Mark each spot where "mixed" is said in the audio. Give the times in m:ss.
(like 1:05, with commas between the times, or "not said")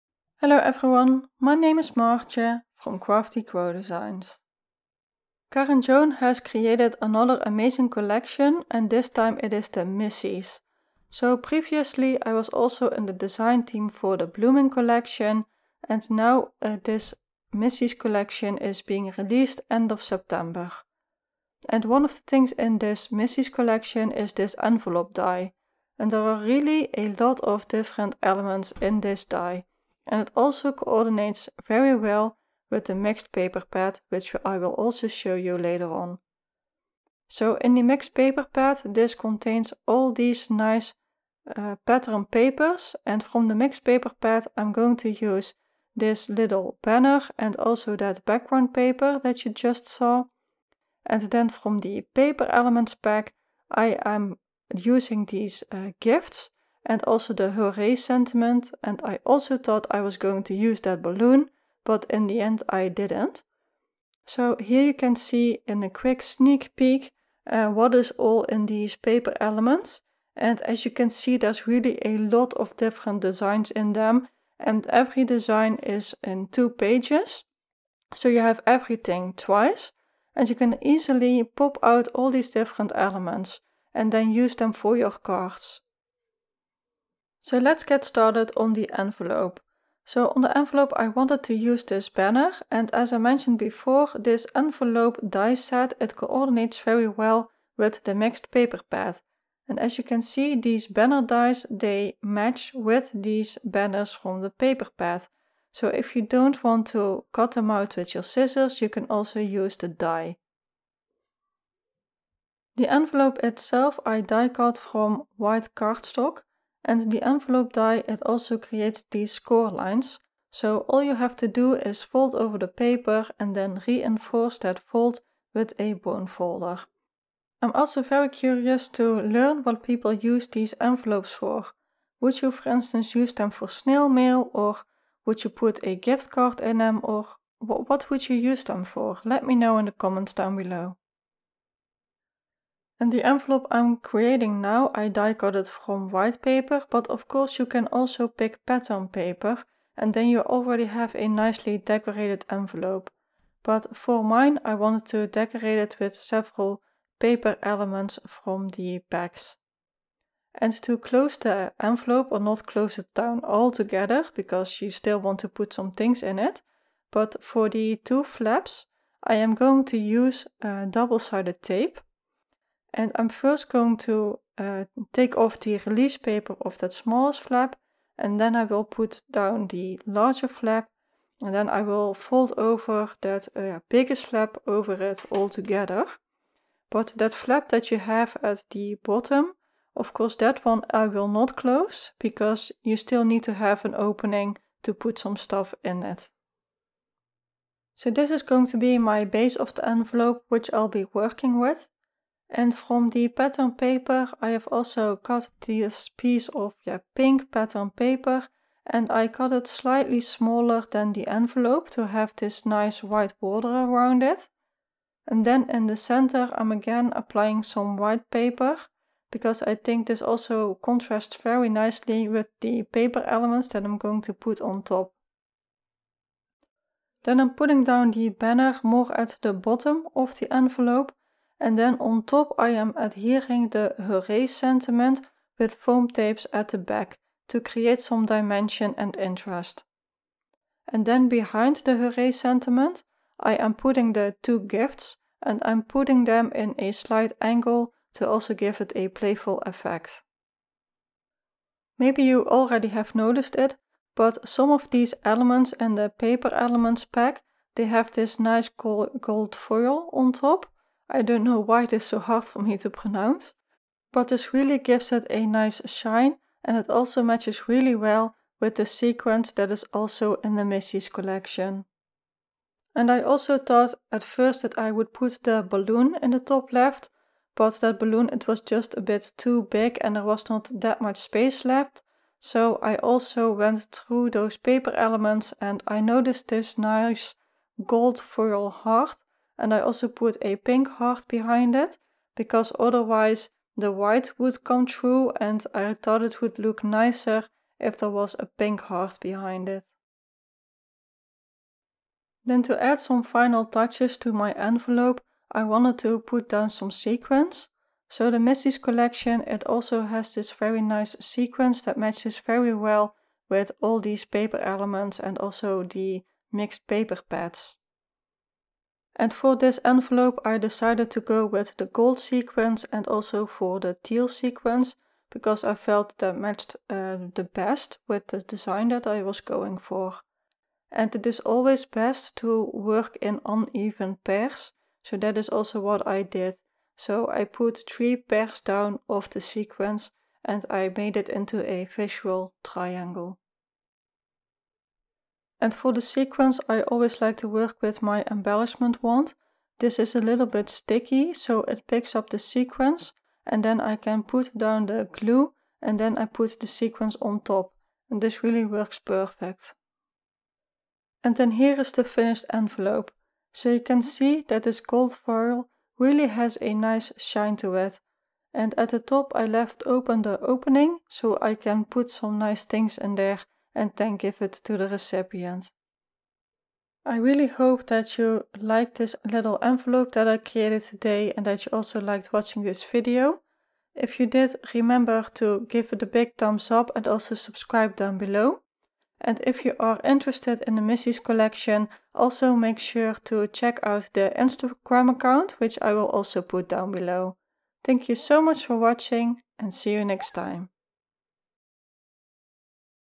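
0:32, 0:37, 0:43, 1:38, 5:16.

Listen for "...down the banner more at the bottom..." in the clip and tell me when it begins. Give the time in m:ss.
3:47.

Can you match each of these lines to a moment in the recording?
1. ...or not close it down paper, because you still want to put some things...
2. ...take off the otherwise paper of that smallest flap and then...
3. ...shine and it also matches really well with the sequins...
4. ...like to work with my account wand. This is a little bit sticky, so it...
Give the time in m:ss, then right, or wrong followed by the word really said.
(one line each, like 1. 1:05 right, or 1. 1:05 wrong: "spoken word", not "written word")
1. 2:42 wrong: "altogether", not "paper"
2. 2:55 wrong: "release", not "otherwise"
3. 4:25 right
4. 5:47 wrong: "embellishment", not "account".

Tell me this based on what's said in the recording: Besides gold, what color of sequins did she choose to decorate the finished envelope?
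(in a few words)
Teal.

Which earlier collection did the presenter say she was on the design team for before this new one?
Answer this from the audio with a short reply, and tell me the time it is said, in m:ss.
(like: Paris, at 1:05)
Blooming, at 0:14.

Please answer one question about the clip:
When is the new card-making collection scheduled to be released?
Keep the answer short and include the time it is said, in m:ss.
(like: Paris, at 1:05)
End of September, at 0:19.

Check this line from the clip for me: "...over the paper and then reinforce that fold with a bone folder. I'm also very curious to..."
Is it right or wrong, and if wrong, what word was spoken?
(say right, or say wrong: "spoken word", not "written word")
right.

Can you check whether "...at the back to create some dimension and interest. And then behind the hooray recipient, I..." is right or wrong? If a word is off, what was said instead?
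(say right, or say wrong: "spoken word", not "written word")
wrong: "sentiment", not "recipient".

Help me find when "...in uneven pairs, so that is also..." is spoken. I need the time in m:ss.
5:33.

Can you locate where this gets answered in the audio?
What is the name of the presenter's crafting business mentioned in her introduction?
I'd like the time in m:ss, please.
0:02.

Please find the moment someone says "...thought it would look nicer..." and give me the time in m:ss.
4:55.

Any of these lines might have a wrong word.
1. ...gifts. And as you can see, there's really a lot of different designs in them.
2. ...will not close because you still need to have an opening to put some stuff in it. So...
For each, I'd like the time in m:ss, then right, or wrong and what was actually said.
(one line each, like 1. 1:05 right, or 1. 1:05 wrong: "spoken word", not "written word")
1. 1:09 wrong: "elements", not "gifts"
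2. 3:11 right.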